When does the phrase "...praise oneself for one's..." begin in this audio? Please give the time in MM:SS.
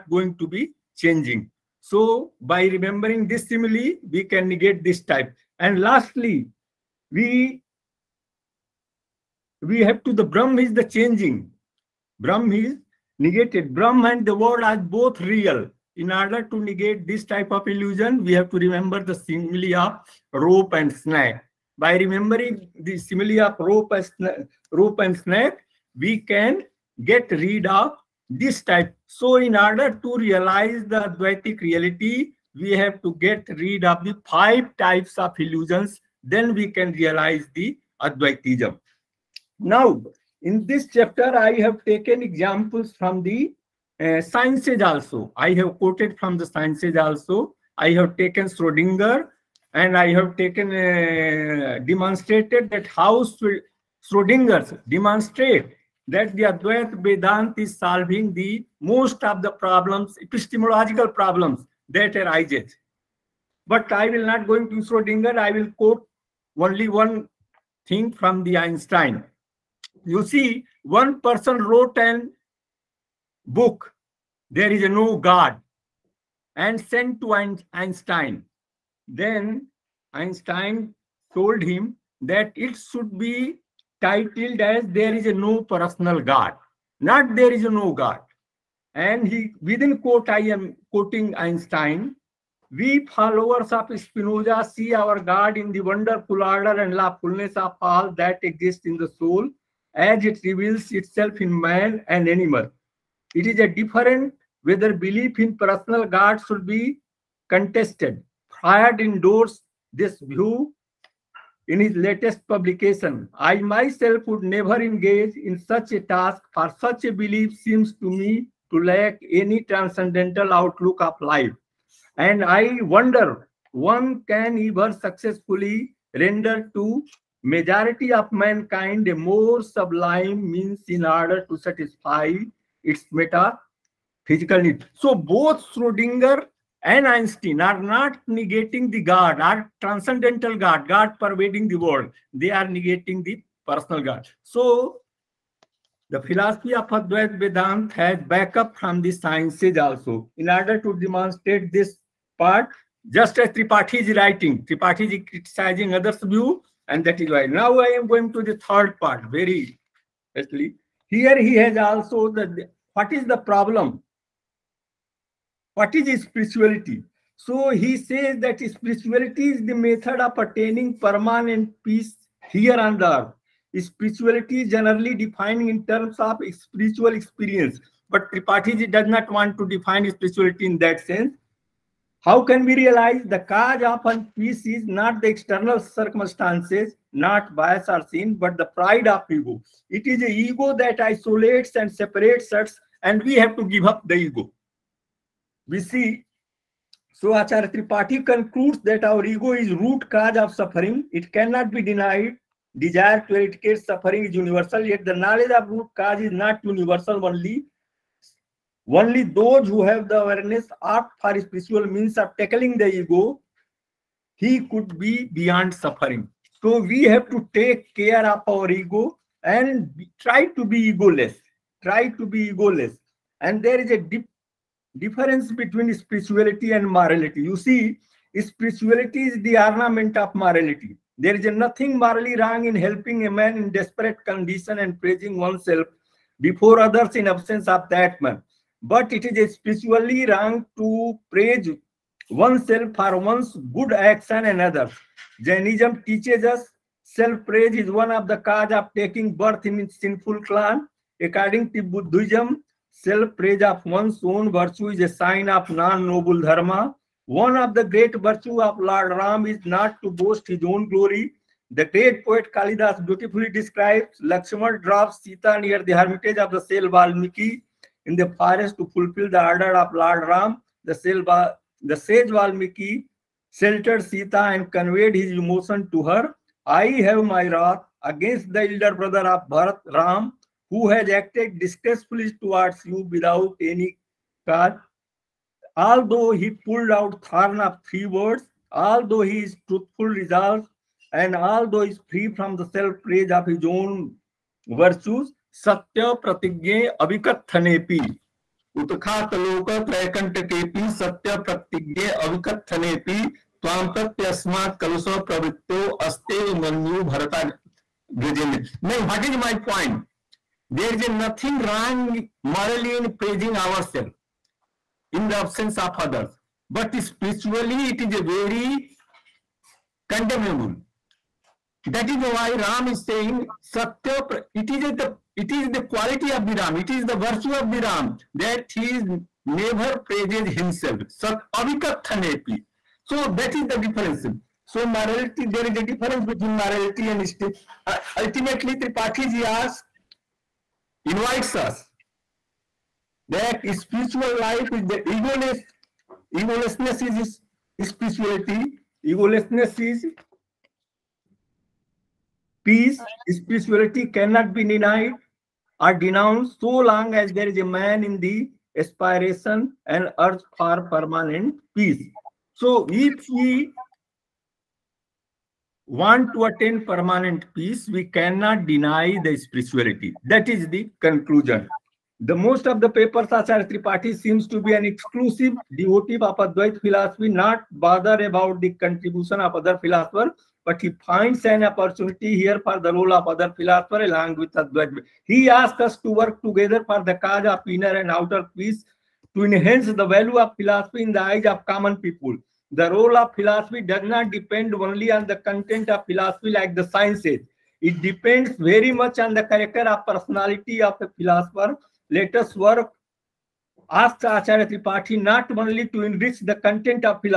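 04:01.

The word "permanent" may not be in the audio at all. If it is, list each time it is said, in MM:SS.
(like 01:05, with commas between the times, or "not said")
02:50, 06:00, 06:06.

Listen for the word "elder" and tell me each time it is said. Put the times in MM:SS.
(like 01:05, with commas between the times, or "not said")
04:38.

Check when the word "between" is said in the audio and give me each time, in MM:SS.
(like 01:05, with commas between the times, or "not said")
03:45, 05:36.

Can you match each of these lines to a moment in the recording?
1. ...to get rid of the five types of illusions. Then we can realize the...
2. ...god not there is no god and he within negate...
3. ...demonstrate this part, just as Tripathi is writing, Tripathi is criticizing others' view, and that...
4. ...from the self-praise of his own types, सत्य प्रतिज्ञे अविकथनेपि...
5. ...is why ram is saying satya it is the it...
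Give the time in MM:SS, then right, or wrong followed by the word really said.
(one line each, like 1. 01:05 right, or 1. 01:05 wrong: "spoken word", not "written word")
1. 00:33 right
2. 01:26 wrong: "quote", not "negate"
3. 02:30 right
4. 04:52 wrong: "virtues", not "types"
5. 05:22 right.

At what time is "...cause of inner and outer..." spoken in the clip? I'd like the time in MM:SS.
06:27.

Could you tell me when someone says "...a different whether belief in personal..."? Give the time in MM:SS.
01:43.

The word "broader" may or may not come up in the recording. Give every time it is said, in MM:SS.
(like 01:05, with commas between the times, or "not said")
not said.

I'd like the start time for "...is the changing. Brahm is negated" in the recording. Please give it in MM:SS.
00:10.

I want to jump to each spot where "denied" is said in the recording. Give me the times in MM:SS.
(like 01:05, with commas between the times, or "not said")
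03:21, 05:54.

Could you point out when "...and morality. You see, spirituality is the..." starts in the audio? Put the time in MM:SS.
03:46.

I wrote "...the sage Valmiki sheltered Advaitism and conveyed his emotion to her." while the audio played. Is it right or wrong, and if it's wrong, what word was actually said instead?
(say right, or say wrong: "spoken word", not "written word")
wrong: "Sita", not "Advaitism".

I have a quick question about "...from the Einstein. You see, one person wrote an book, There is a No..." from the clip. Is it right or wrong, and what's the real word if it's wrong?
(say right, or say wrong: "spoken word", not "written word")
right.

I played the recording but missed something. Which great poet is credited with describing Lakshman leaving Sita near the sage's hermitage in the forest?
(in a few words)
Kalidas.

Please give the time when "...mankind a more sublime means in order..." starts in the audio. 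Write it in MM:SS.
02:08.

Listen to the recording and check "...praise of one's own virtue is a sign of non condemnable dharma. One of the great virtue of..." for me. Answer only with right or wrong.
wrong.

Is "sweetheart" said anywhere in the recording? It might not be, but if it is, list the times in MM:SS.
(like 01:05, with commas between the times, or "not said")
not said.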